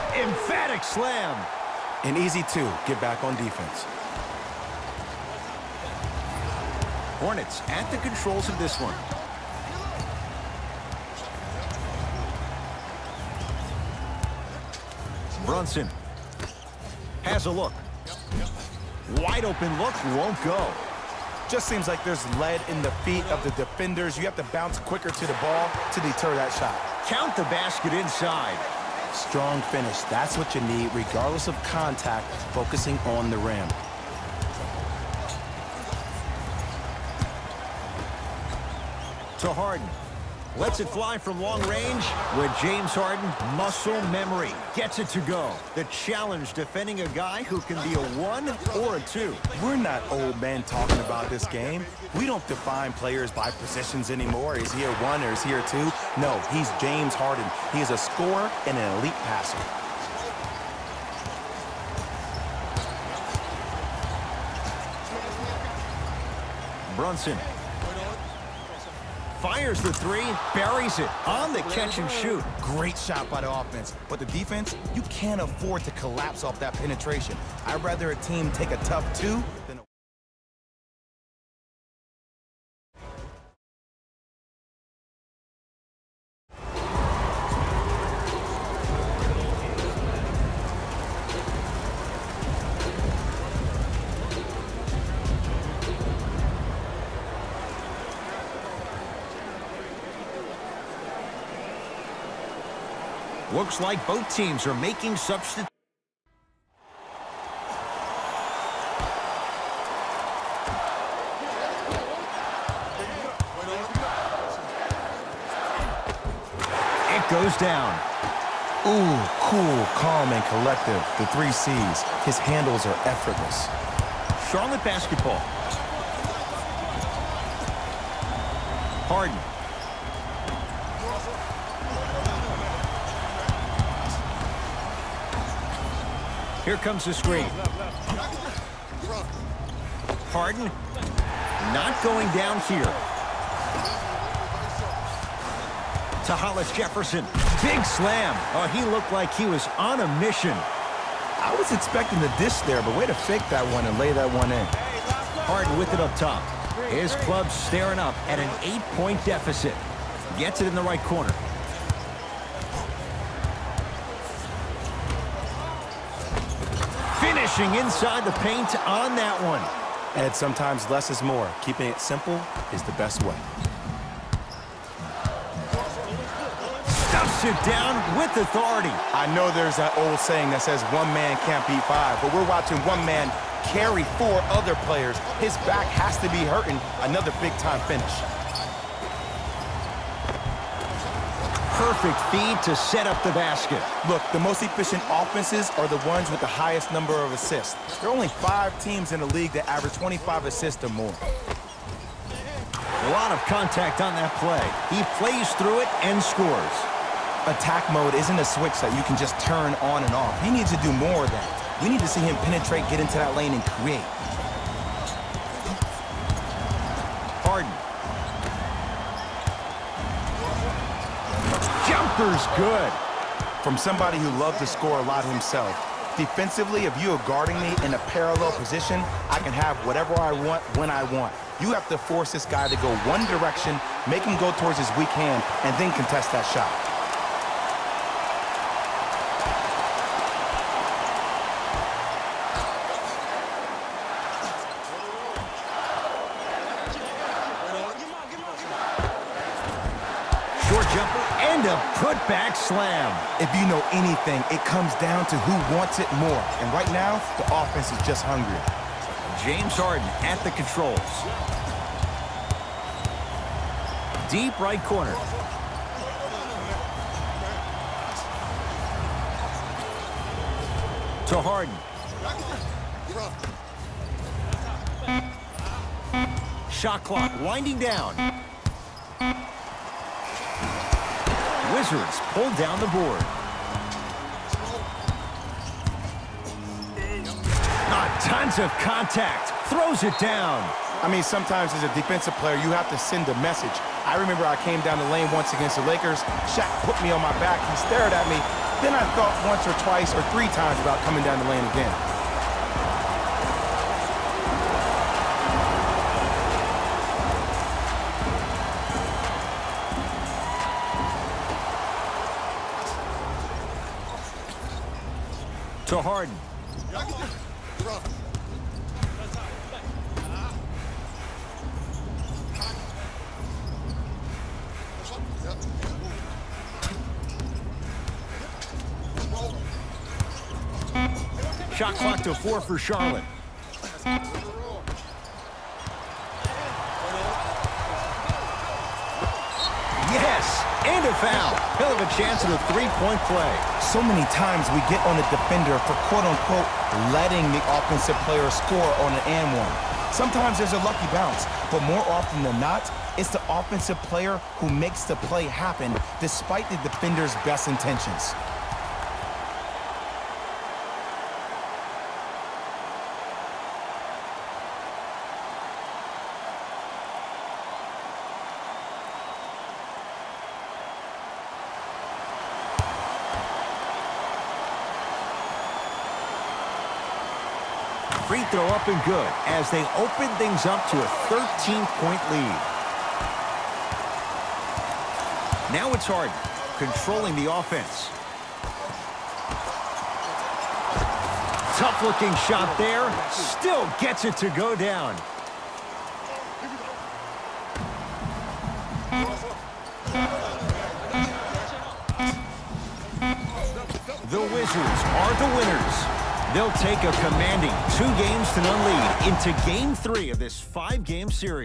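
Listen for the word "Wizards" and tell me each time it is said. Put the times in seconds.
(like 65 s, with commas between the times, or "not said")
281 s, 404 s.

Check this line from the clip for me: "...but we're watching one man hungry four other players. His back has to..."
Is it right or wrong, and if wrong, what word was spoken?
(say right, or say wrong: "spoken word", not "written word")
wrong: "carry", not "hungry".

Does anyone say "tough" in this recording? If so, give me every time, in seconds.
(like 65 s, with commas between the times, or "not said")
78 s, 391 s.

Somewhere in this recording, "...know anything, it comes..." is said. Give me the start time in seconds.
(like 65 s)
253 s.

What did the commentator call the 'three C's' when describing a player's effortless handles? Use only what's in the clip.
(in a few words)
Cool, calm, and collective.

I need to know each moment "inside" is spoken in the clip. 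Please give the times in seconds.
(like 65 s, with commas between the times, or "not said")
27 s, 167 s.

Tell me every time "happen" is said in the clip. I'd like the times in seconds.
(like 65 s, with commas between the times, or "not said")
355 s.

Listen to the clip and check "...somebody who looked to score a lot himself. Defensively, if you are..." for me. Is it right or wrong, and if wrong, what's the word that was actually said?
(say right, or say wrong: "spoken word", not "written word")
wrong: "loved", not "looked".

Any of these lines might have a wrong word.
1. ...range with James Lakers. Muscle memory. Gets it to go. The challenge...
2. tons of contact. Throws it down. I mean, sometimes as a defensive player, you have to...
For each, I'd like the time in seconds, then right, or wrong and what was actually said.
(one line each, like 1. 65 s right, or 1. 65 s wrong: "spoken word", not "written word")
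1. 41 s wrong: "Harden", not "Lakers"
2. 288 s right.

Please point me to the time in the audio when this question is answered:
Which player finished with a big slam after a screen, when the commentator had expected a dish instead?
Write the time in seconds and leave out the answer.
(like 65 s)
146 s.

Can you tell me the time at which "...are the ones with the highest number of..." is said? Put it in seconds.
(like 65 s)
195 s.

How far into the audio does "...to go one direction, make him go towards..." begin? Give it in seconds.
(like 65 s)
232 s.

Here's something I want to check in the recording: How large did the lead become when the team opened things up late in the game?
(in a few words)
13 points.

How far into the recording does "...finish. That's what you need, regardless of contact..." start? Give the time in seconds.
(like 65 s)
29 s.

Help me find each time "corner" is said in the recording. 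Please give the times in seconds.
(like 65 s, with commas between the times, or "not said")
161 s, 264 s.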